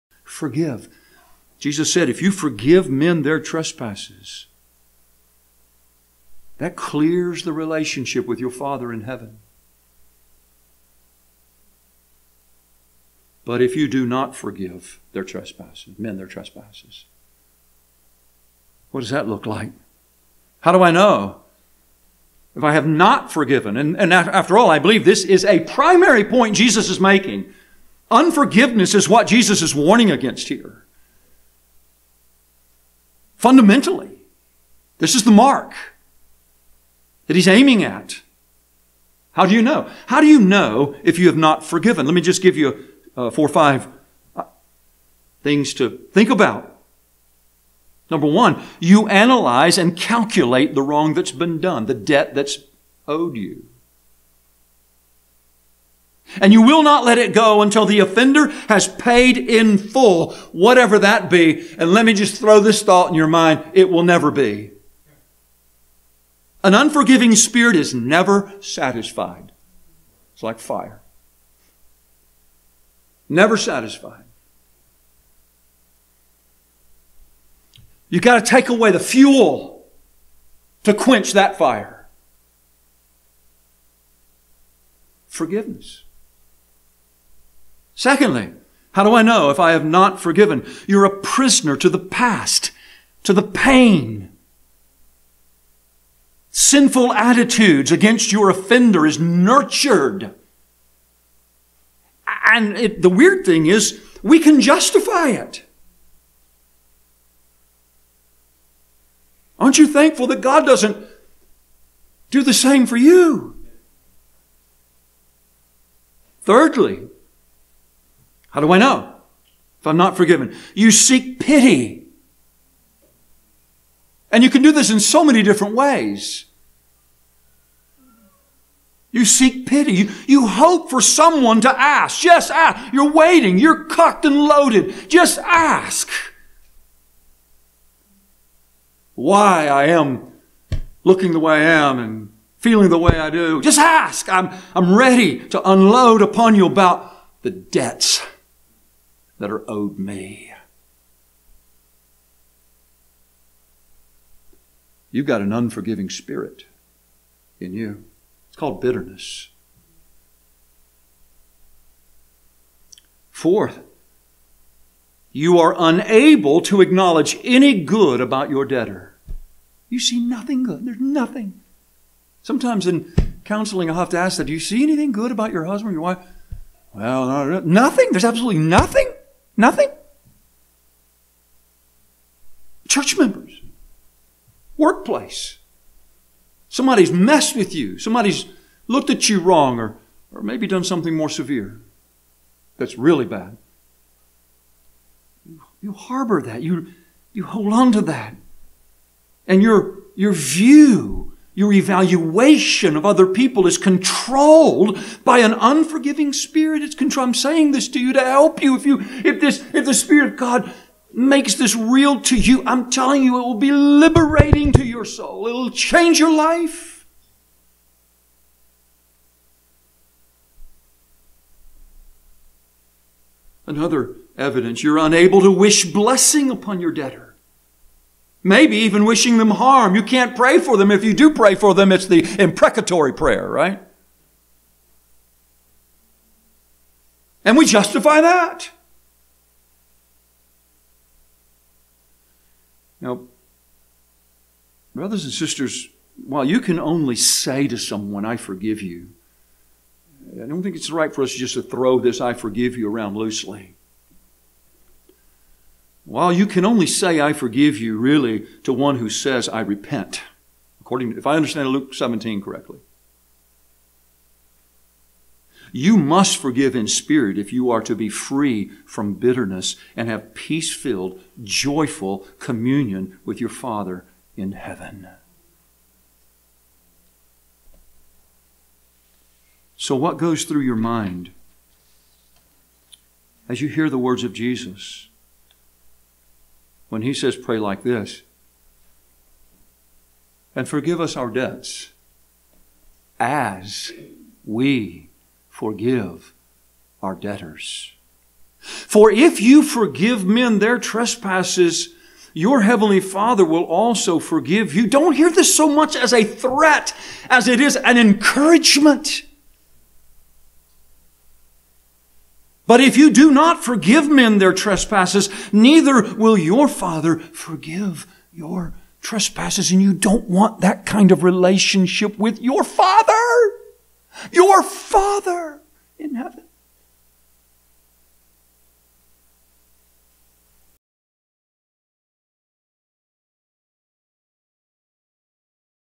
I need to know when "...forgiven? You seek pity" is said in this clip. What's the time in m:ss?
2:00.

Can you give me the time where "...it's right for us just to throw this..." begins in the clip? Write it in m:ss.
4:10.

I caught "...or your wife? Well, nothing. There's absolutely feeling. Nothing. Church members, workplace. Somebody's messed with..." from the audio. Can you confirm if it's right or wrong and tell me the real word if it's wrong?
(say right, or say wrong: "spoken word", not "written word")
wrong: "nothing", not "feeling".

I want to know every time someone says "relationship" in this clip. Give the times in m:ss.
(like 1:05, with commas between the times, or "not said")
0:07, 5:21.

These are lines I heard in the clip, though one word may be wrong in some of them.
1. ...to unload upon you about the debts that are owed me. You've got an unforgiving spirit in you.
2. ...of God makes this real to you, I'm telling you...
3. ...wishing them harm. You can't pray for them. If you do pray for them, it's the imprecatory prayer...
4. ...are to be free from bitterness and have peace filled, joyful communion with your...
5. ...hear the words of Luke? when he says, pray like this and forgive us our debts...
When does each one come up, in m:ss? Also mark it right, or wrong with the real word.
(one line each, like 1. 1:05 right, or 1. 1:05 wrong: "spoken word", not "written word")
1. 2:25 right
2. 3:30 right
3. 3:49 right
4. 4:27 right
5. 4:43 wrong: "Jesus", not "Luke".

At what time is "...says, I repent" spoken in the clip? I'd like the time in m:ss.
4:19.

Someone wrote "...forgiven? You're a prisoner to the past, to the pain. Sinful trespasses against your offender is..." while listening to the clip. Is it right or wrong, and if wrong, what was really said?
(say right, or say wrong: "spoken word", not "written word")
wrong: "attitudes", not "trespasses".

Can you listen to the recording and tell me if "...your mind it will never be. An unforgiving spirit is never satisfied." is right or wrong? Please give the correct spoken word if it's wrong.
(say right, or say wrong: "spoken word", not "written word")
right.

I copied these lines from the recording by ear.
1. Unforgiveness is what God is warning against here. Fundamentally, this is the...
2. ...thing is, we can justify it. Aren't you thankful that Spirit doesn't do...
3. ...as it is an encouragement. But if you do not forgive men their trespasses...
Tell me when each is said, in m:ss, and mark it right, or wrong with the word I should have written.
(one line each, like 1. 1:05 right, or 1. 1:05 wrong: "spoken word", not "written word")
1. 0:28 wrong: "Jesus", not "God"
2. 1:43 wrong: "God", not "Spirit"
3. 5:07 right.